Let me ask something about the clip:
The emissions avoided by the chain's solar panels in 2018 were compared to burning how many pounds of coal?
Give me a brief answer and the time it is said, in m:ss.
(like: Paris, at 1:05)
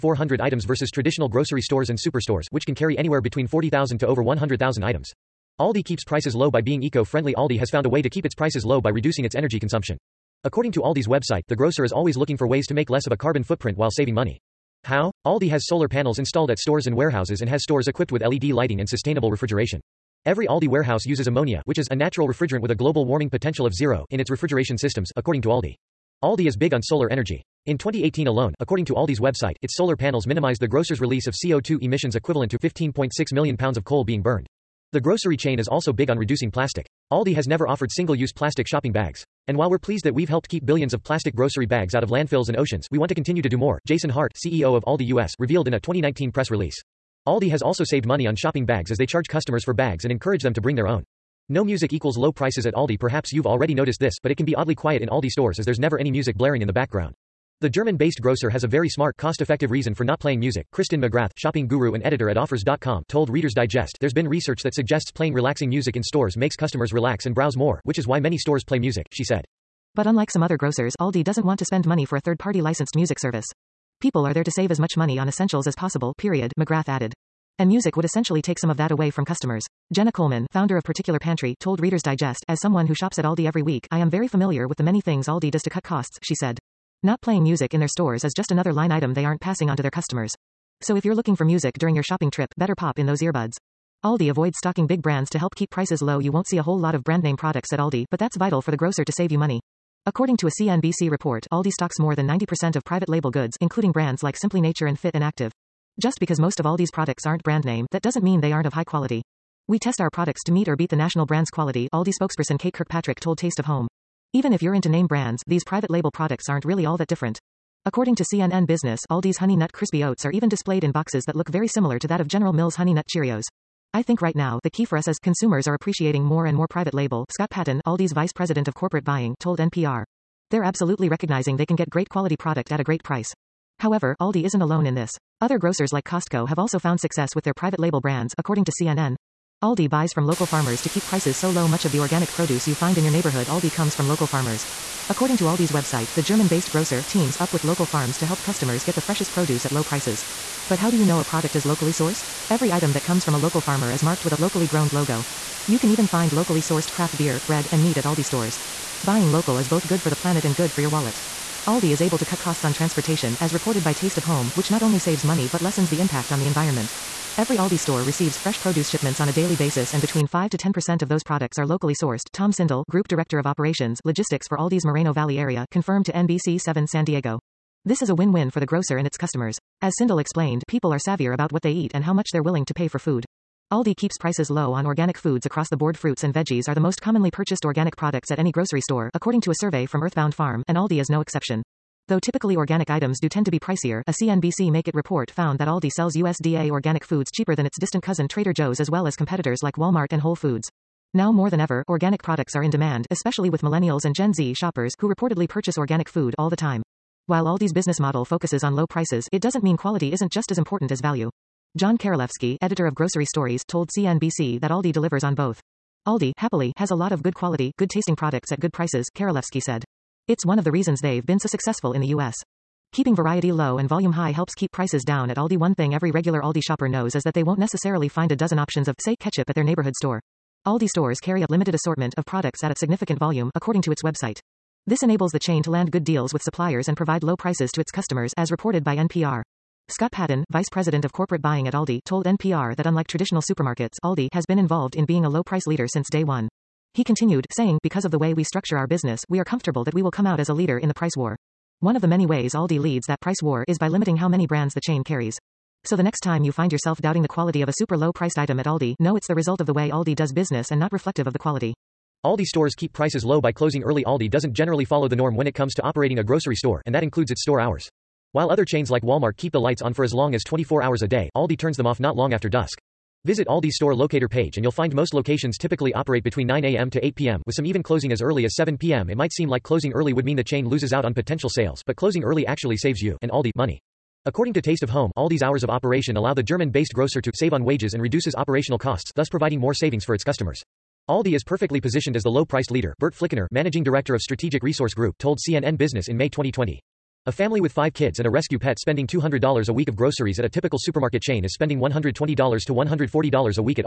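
15.6 million, at 0:32.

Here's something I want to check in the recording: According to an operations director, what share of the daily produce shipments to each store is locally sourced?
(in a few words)
5 to 10%.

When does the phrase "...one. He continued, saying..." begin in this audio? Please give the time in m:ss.
4:06.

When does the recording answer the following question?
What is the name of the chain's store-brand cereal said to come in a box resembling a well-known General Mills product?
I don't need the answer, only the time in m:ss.
1:59.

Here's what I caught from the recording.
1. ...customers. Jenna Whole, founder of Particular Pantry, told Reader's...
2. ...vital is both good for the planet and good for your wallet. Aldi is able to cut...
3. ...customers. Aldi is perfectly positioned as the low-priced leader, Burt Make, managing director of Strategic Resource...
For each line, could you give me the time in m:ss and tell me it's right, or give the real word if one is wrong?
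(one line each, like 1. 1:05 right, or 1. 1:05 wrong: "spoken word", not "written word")
1. 1:19 wrong: "Coleman", not "Whole"
2. 2:39 wrong: "local", not "vital"
3. 4:50 wrong: "Flickinger", not "Make".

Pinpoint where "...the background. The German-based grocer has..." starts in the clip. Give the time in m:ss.
0:56.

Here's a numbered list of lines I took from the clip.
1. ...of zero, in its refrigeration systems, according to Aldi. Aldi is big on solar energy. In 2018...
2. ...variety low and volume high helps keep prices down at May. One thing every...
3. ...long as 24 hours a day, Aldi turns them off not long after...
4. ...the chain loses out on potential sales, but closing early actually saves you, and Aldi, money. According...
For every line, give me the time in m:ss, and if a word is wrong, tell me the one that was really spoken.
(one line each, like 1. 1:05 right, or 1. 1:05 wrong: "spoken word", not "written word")
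1. 0:23 right
2. 3:43 wrong: "Aldi", not "May"
3. 4:30 right
4. 4:40 right.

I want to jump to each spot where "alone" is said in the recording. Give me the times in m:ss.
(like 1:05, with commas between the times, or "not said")
0:28, 2:14.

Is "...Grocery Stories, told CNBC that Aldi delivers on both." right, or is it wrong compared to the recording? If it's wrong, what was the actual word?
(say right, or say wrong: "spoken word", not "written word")
right.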